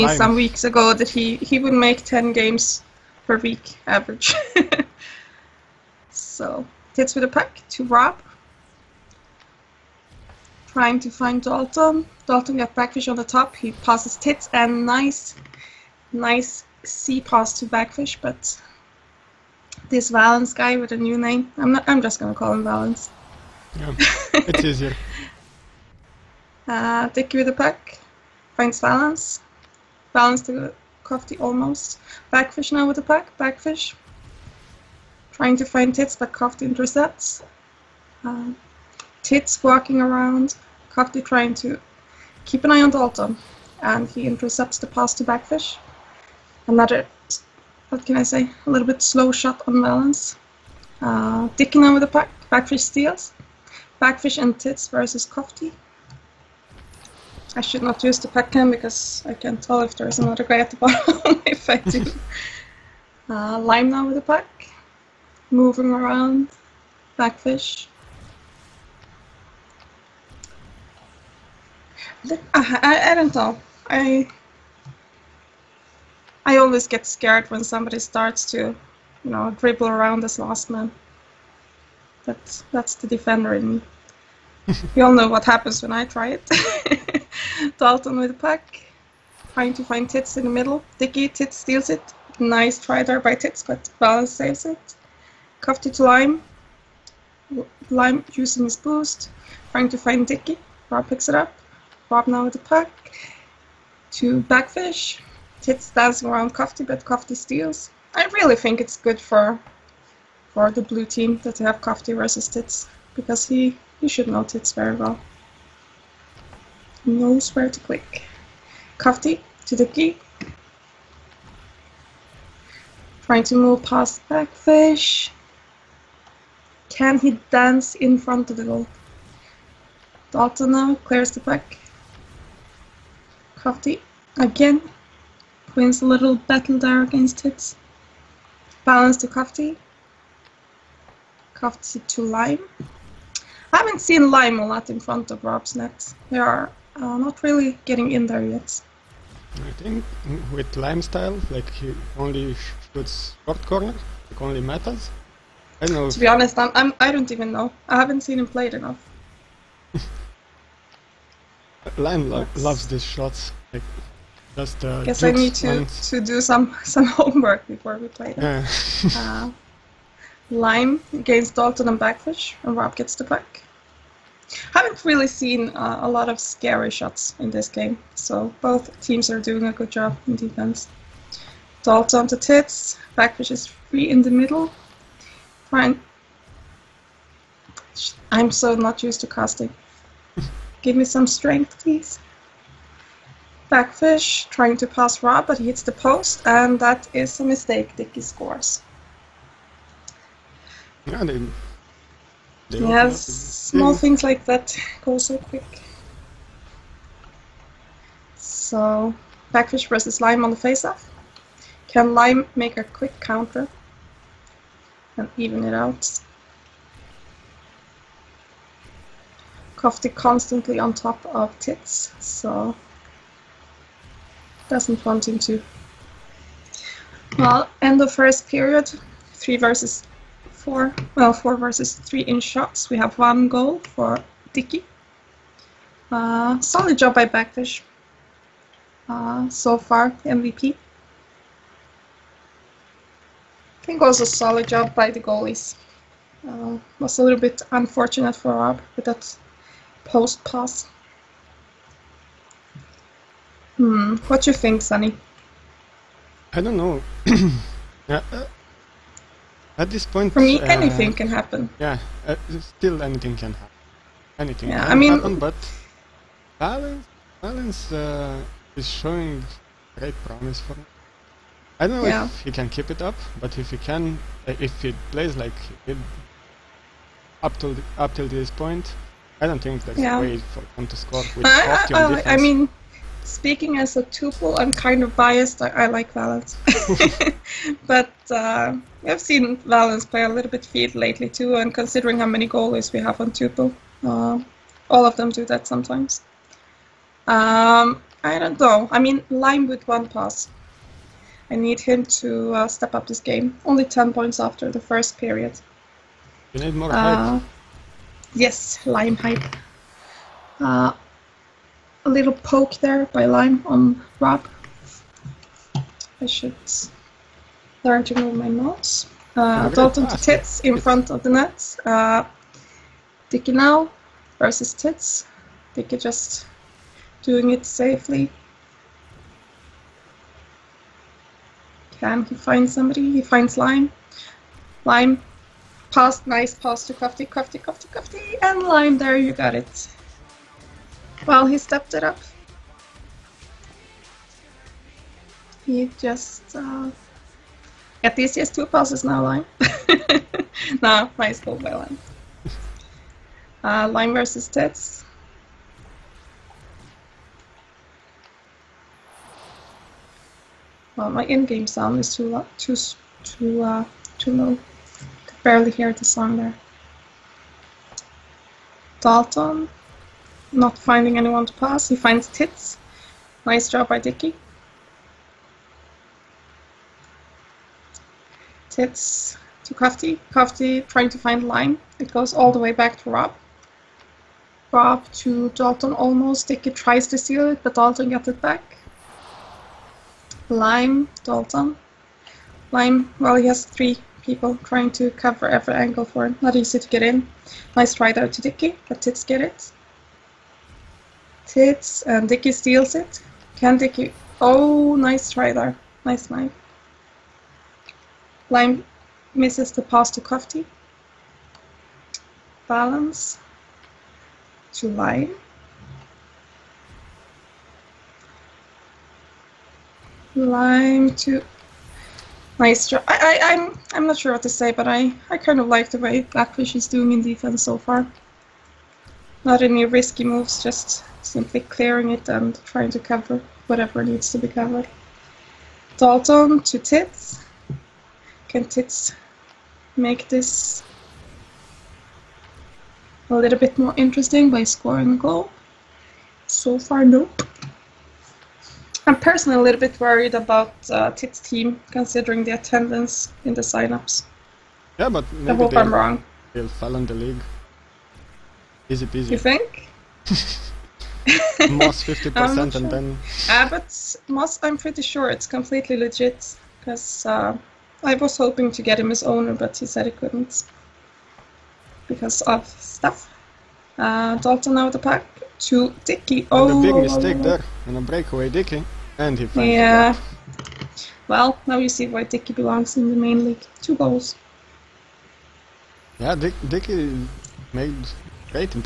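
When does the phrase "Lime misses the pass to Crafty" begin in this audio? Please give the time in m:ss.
6:48.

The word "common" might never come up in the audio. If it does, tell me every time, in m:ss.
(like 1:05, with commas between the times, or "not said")
not said.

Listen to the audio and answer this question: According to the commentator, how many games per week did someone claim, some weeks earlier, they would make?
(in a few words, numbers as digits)
10.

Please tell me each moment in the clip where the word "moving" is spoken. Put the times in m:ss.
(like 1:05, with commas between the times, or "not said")
1:05.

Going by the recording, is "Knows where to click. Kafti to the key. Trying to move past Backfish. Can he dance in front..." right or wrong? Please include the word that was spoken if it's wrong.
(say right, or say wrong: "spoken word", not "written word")
right.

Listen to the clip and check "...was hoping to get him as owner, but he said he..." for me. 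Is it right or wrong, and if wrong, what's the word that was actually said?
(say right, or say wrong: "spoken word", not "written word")
right.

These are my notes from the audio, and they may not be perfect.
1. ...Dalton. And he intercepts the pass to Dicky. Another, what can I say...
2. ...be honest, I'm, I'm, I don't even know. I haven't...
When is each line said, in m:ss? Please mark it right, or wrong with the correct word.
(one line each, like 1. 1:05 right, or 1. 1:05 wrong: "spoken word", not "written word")
1. 0:42 wrong: "Backfish", not "Dicky"
2. 2:36 right.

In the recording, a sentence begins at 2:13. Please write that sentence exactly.
Kafti again wins a little battle there against it.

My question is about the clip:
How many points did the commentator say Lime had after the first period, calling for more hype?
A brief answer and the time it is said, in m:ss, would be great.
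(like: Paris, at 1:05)
10, at 5:03.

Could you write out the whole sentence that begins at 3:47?
Well, end of first period, 3 versus four, well, four versus three in shots.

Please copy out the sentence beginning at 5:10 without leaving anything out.
Uh, a little poke there by Lime on Rob.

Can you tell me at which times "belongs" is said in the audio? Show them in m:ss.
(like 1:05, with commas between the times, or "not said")
8:02.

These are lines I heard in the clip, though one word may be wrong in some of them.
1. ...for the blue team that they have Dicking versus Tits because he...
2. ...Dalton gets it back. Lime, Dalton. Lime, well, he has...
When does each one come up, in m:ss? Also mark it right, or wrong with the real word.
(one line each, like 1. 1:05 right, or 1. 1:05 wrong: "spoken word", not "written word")
1. 1:50 wrong: "Cofty", not "Dicking"
2. 6:27 right.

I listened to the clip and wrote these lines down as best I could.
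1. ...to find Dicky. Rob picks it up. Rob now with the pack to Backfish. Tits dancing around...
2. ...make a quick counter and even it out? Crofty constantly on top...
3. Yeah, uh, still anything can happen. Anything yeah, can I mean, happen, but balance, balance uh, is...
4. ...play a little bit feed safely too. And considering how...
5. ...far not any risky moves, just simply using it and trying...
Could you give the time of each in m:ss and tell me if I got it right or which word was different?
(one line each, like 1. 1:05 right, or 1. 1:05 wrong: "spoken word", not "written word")
1. 1:39 right
2. 3:32 right
3. 4:21 right
4. 4:50 wrong: "lately", not "safely"
5. 7:07 wrong: "clearing", not "using".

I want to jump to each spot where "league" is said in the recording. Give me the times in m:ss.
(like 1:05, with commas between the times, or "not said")
7:37, 8:03.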